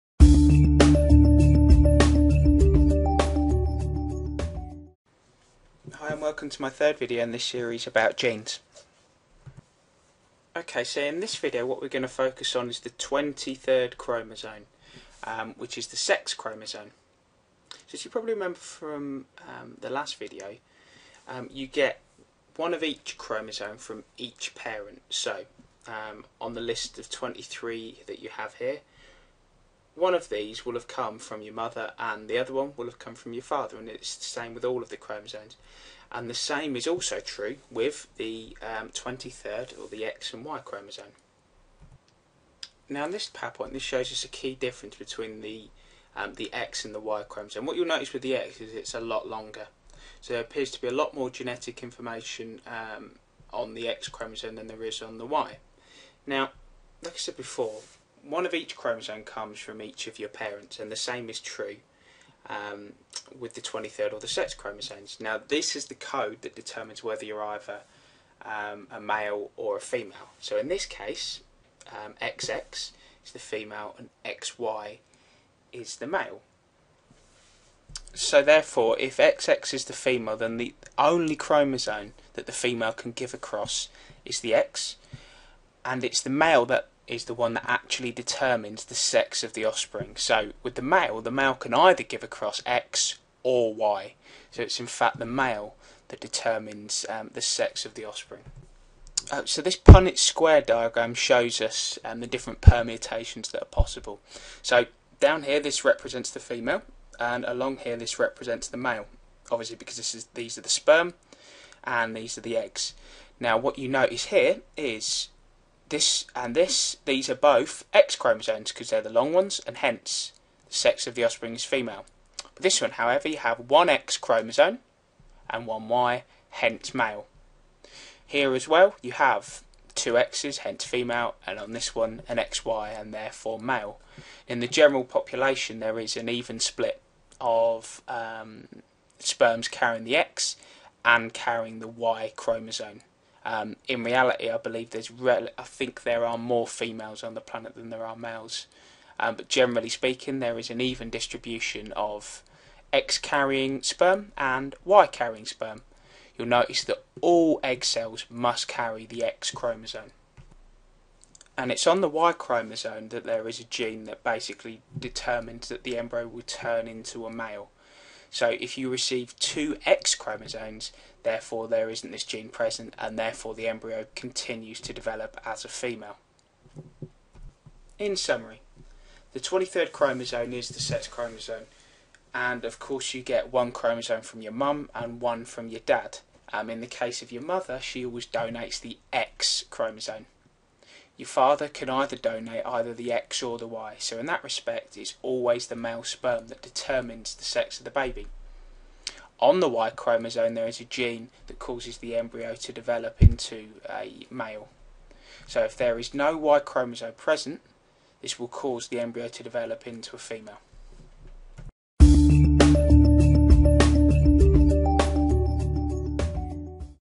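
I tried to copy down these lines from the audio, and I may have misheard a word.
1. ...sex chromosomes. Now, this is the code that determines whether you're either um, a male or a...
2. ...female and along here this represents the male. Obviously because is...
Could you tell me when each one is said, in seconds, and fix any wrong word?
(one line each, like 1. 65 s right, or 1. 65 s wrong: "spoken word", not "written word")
1. 64 s right
2. 106 s right.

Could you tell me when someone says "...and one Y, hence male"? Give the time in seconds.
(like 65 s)
125 s.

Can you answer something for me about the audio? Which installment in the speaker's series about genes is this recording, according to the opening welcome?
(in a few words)
third.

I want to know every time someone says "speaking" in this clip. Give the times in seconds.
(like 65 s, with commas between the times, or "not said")
149 s.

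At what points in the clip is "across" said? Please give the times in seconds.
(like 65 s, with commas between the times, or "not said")
83 s, 92 s.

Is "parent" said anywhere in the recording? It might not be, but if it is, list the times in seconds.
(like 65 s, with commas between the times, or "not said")
24 s, 60 s.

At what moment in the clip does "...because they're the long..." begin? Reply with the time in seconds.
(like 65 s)
118 s.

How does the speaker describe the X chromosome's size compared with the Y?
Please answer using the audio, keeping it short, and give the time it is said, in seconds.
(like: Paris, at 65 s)
a lot longer, at 48 s.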